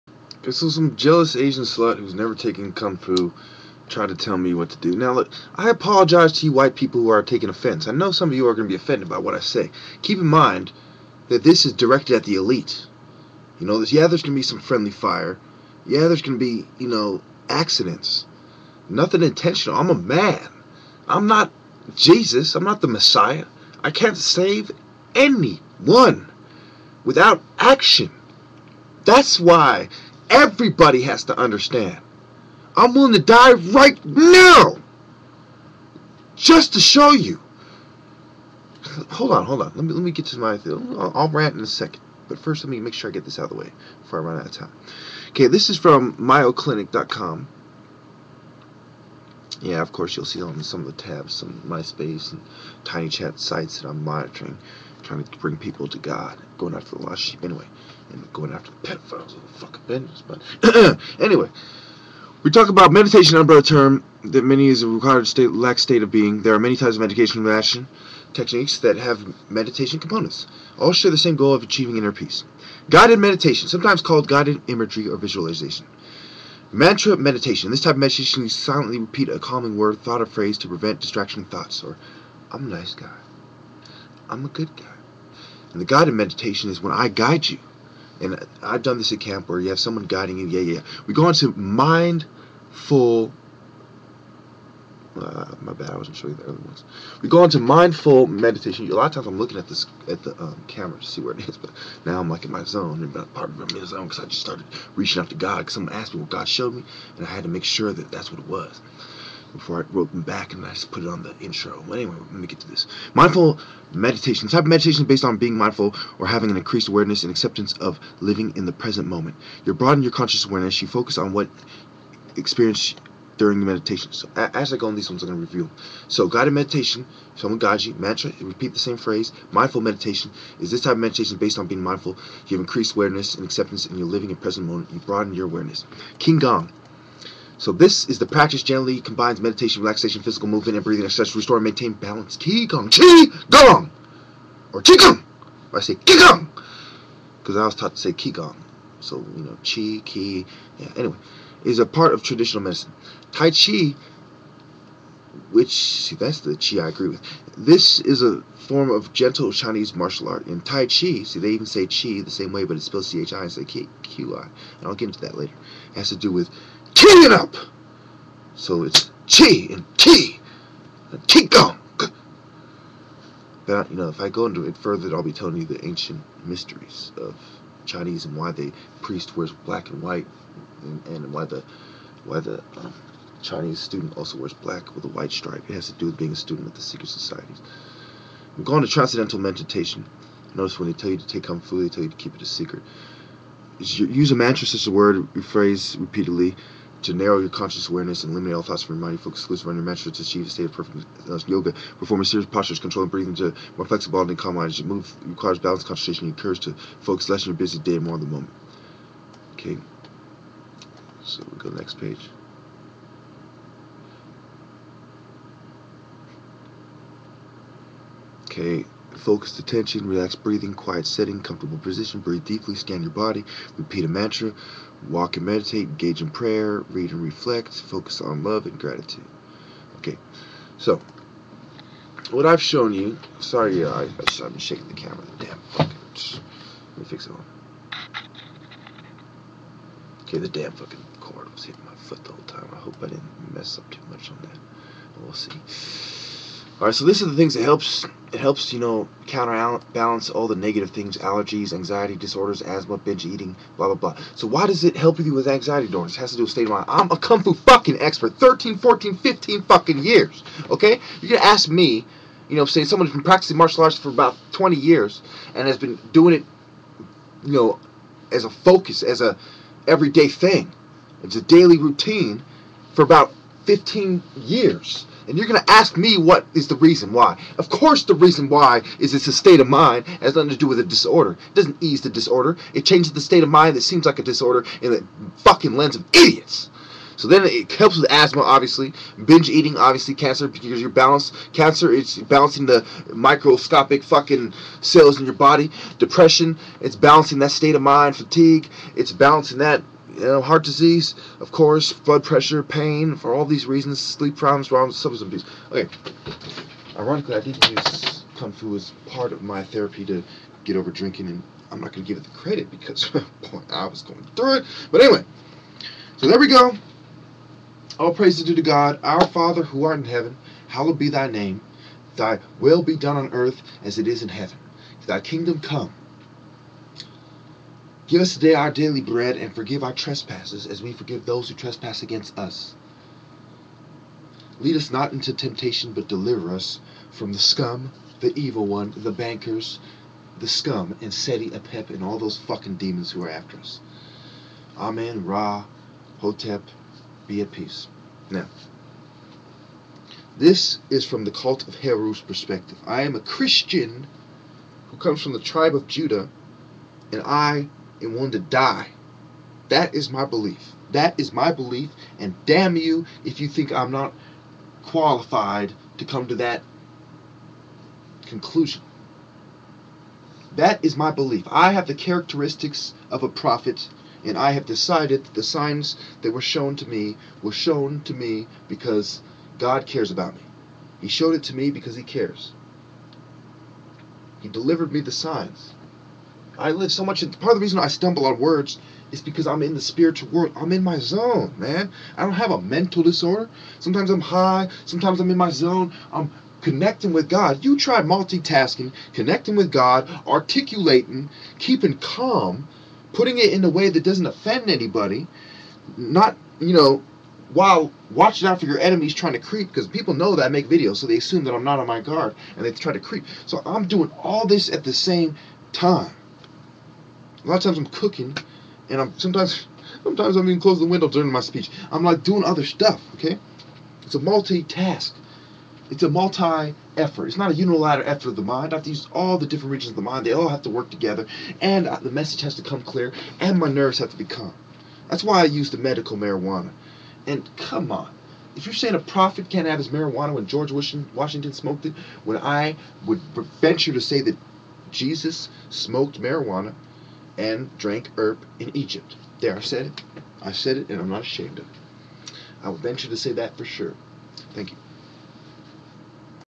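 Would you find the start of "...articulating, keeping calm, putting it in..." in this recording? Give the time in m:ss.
6:40.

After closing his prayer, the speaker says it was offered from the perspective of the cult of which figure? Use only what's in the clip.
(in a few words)
Heru.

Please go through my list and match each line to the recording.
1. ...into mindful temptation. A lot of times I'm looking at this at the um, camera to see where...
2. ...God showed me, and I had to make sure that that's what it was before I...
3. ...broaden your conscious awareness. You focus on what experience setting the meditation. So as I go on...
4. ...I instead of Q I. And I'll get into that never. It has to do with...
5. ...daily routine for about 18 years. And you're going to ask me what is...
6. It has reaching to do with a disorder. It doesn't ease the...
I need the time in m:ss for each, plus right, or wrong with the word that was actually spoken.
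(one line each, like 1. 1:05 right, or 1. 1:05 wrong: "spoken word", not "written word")
1. 1:37 wrong: "meditation", not "temptation"
2. 1:46 right
3. 1:59 wrong: "during", not "setting"
4. 2:43 wrong: "later", not "never"
5. 4:31 wrong: "15", not "18"
6. 4:40 wrong: "nothing", not "reaching".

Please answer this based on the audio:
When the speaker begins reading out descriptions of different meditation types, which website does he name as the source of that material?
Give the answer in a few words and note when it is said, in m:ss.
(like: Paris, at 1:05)
mayoclinic.com, at 0:46.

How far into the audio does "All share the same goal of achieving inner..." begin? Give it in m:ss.
1:10.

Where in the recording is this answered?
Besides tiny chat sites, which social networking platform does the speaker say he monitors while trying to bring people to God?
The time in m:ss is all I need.
0:51.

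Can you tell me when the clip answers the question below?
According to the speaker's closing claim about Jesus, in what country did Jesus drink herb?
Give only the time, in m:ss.
7:28.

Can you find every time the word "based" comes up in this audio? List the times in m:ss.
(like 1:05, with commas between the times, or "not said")
1:55, 2:11.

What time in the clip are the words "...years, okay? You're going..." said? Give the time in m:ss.
4:19.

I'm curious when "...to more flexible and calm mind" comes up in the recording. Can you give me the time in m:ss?
3:23.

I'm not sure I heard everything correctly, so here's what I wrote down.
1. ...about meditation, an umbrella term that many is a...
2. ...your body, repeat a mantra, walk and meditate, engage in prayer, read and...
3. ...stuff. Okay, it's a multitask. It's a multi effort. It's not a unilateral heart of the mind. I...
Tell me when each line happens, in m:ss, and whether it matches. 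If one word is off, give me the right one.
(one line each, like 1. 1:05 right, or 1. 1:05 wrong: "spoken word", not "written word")
1. 1:02 right
2. 3:43 right
3. 7:02 wrong: "effort", not "heart".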